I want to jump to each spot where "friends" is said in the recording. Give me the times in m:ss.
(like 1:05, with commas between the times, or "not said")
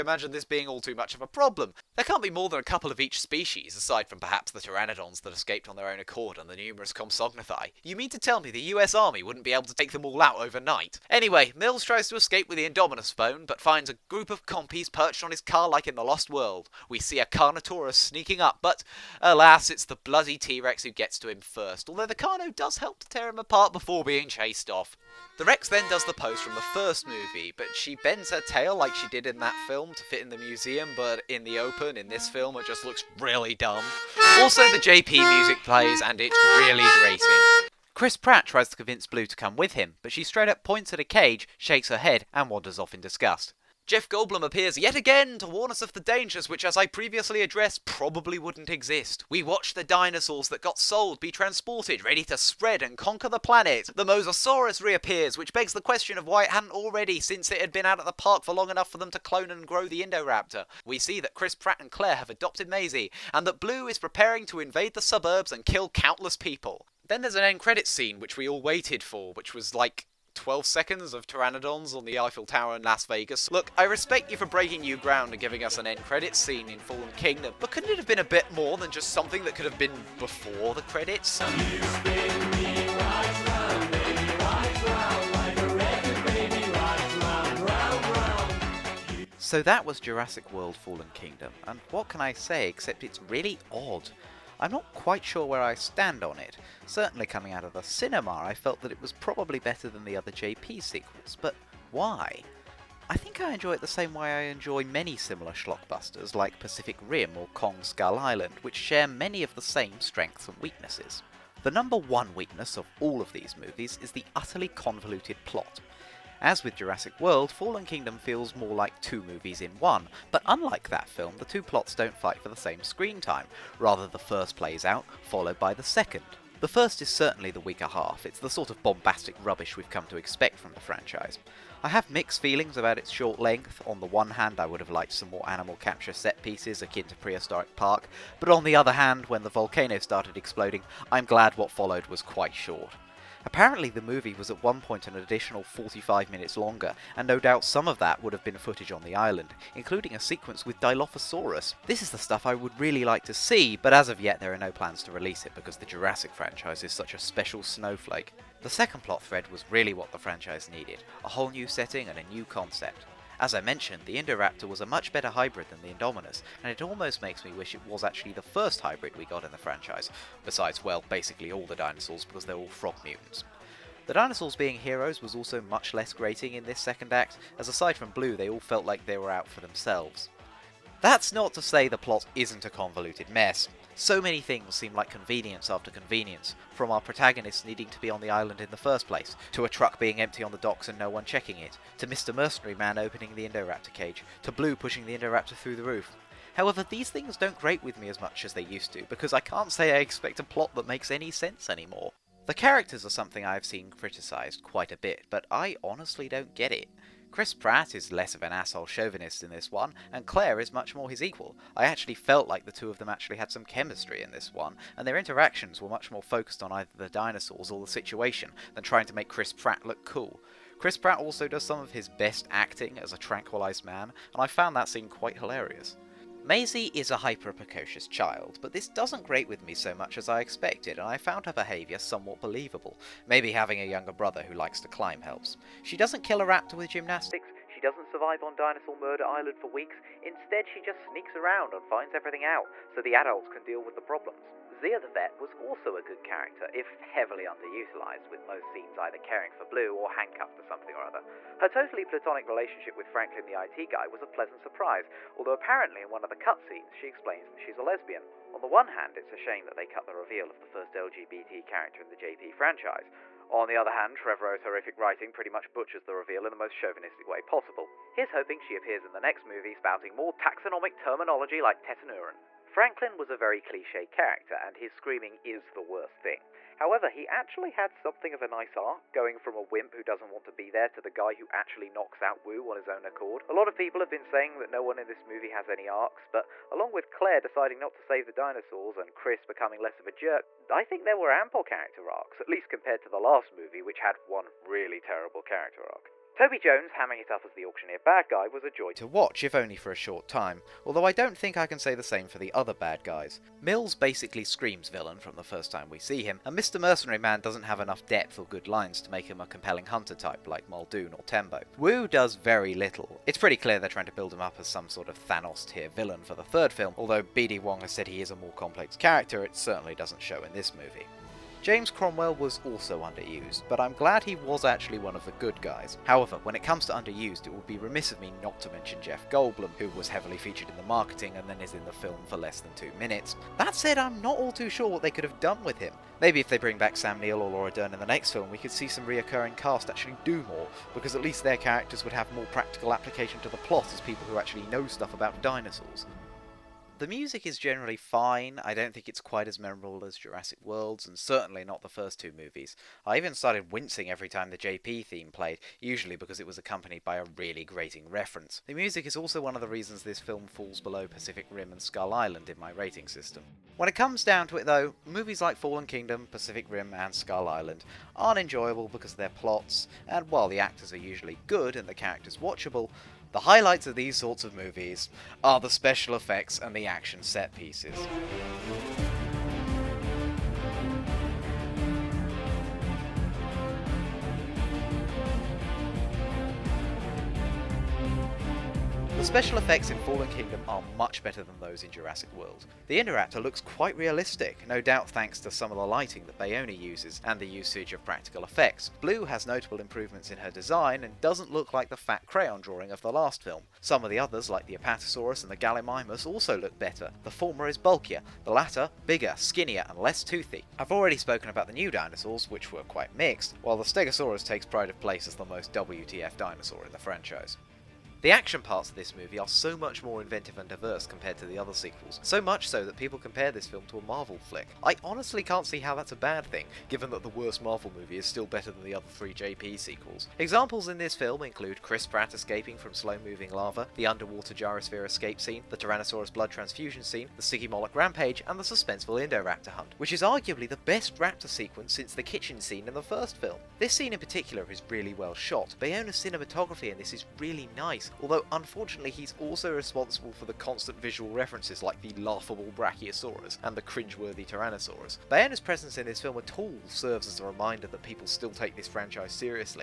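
not said.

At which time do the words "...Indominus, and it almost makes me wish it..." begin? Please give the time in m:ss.
2:45.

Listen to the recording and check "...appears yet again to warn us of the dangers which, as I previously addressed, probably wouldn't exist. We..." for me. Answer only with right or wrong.
right.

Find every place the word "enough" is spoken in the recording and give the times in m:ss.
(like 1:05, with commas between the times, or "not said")
0:58, 5:07.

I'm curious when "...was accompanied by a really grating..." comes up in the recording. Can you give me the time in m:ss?
5:56.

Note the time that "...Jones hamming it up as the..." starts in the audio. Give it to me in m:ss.
4:56.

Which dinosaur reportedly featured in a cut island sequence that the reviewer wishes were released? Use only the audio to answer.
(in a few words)
Dilophosaurus.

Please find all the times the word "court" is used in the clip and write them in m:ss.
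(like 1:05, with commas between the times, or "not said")
not said.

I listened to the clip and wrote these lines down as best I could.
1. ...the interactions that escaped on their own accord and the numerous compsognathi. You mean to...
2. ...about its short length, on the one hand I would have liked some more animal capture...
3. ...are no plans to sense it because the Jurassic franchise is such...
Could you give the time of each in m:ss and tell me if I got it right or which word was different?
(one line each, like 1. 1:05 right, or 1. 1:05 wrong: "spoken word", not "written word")
1. 0:04 wrong: "pteranodons", not "interactions"
2. 2:12 right
3. 2:34 wrong: "release", not "sense".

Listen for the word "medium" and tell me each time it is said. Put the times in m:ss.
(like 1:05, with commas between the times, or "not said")
not said.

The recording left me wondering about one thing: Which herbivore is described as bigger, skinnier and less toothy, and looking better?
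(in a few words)
Gallimimus.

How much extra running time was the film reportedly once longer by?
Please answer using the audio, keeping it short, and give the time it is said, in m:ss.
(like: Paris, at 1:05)
45 minutes, at 2:25.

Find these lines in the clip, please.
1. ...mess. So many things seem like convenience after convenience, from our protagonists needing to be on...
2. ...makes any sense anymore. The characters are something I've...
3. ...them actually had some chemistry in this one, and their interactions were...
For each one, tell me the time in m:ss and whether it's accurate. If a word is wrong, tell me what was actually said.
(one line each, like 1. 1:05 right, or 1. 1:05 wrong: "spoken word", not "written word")
1. 3:03 right
2. 3:20 right
3. 3:32 right.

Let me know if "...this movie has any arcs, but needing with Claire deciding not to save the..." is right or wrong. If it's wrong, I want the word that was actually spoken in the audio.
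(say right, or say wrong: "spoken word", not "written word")
wrong: "along", not "needing".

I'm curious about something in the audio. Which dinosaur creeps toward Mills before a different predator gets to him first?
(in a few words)
Carnotaurus.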